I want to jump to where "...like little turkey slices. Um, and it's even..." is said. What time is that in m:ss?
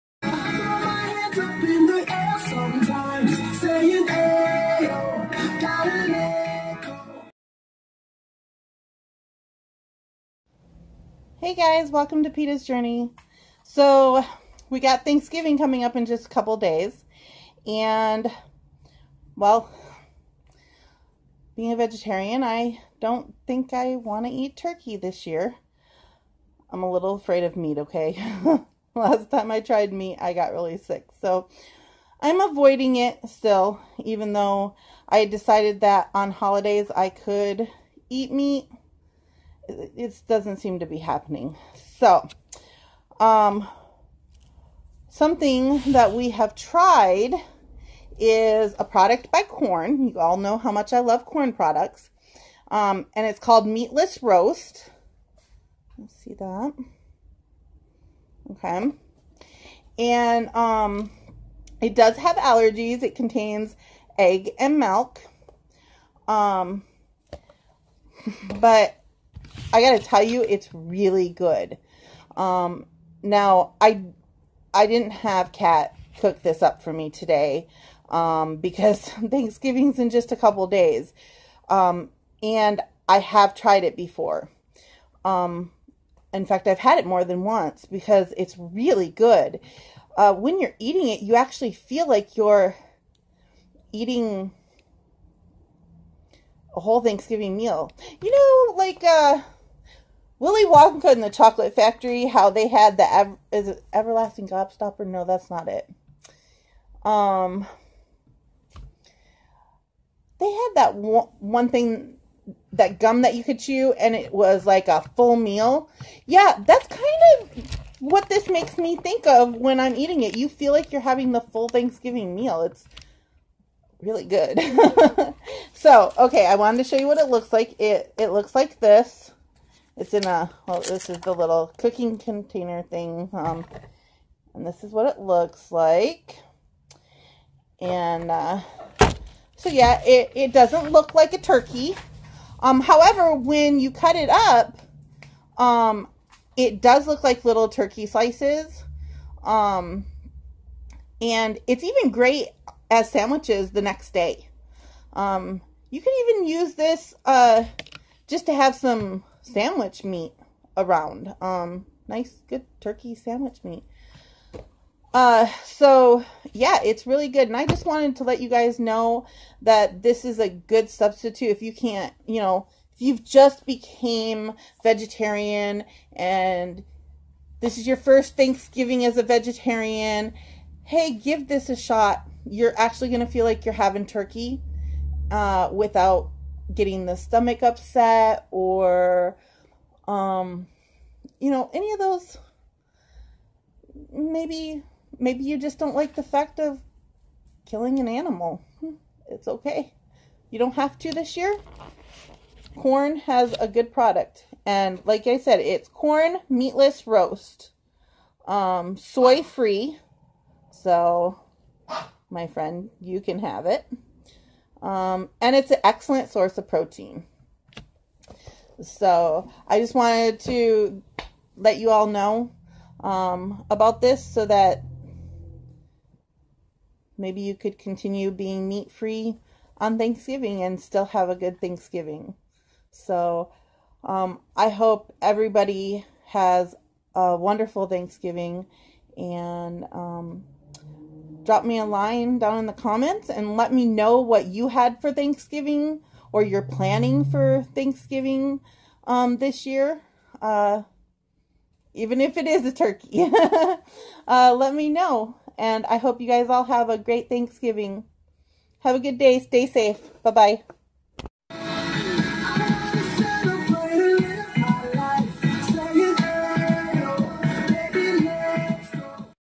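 2:27.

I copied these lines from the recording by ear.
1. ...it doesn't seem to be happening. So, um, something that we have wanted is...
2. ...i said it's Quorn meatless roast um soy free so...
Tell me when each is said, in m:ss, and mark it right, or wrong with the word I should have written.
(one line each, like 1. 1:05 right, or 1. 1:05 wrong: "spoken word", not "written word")
1. 0:39 wrong: "tried", not "wanted"
2. 3:25 right.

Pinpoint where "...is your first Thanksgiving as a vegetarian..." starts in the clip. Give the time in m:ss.
2:57.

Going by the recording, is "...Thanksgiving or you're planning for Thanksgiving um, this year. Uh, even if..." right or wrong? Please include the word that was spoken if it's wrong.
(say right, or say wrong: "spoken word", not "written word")
right.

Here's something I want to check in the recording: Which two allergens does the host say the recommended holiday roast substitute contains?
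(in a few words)
Egg and milk.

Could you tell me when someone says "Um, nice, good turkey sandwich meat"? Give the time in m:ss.
2:41.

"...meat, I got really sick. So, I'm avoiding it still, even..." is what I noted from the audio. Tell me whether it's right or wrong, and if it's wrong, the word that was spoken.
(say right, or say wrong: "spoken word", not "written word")
right.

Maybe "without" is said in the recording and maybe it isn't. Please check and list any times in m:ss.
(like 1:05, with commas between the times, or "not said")
3:05.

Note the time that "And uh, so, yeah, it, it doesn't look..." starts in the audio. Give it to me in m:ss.
2:17.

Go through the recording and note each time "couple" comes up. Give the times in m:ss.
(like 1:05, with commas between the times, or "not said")
0:16, 1:20.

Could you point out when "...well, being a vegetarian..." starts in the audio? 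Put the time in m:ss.
0:19.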